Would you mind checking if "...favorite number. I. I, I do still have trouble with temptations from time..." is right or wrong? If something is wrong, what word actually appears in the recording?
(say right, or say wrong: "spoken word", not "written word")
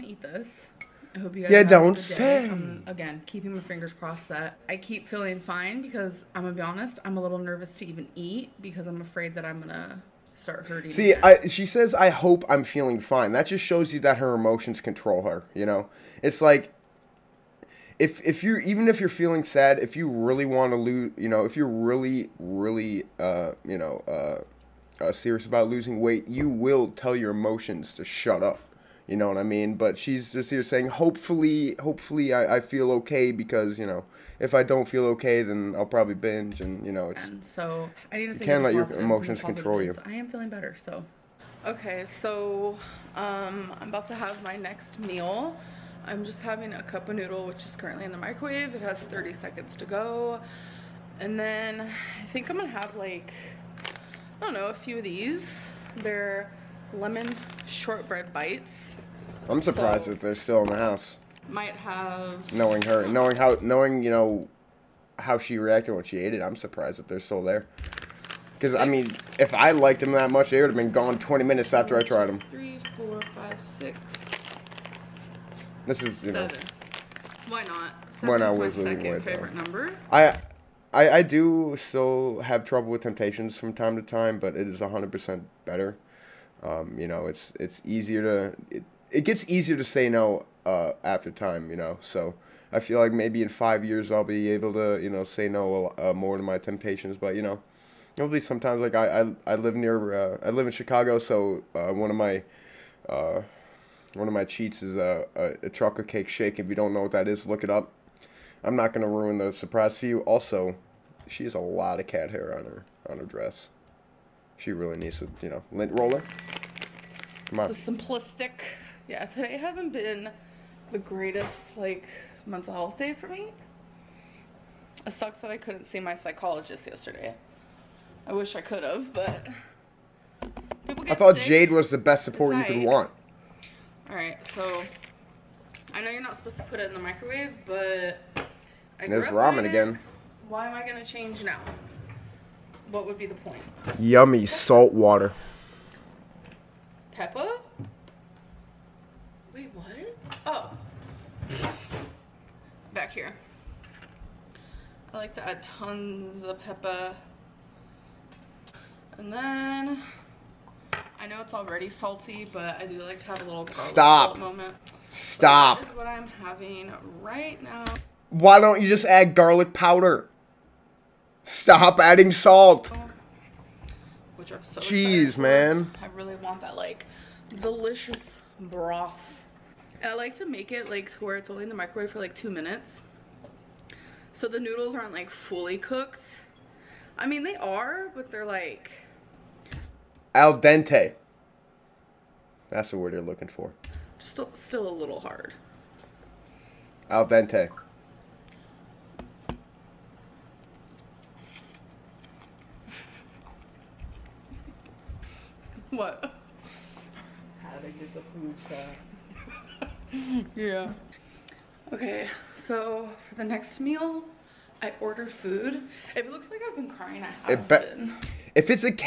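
right.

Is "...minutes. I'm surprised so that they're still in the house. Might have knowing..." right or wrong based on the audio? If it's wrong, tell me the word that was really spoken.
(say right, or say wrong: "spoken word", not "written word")
wrong: "bites", not "minutes".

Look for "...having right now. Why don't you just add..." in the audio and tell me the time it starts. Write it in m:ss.
2:46.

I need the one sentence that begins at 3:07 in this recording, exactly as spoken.
I mean, they are, but they're like...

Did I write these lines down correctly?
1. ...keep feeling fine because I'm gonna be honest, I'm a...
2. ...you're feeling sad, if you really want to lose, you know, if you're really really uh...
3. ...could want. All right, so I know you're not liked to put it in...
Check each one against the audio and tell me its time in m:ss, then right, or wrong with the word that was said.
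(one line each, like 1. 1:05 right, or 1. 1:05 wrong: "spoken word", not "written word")
1. 0:04 right
2. 0:18 right
3. 2:12 wrong: "supposed", not "liked".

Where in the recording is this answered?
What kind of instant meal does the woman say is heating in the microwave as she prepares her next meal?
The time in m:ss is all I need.
0:46.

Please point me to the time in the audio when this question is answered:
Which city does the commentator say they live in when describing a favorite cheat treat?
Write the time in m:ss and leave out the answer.
1:40.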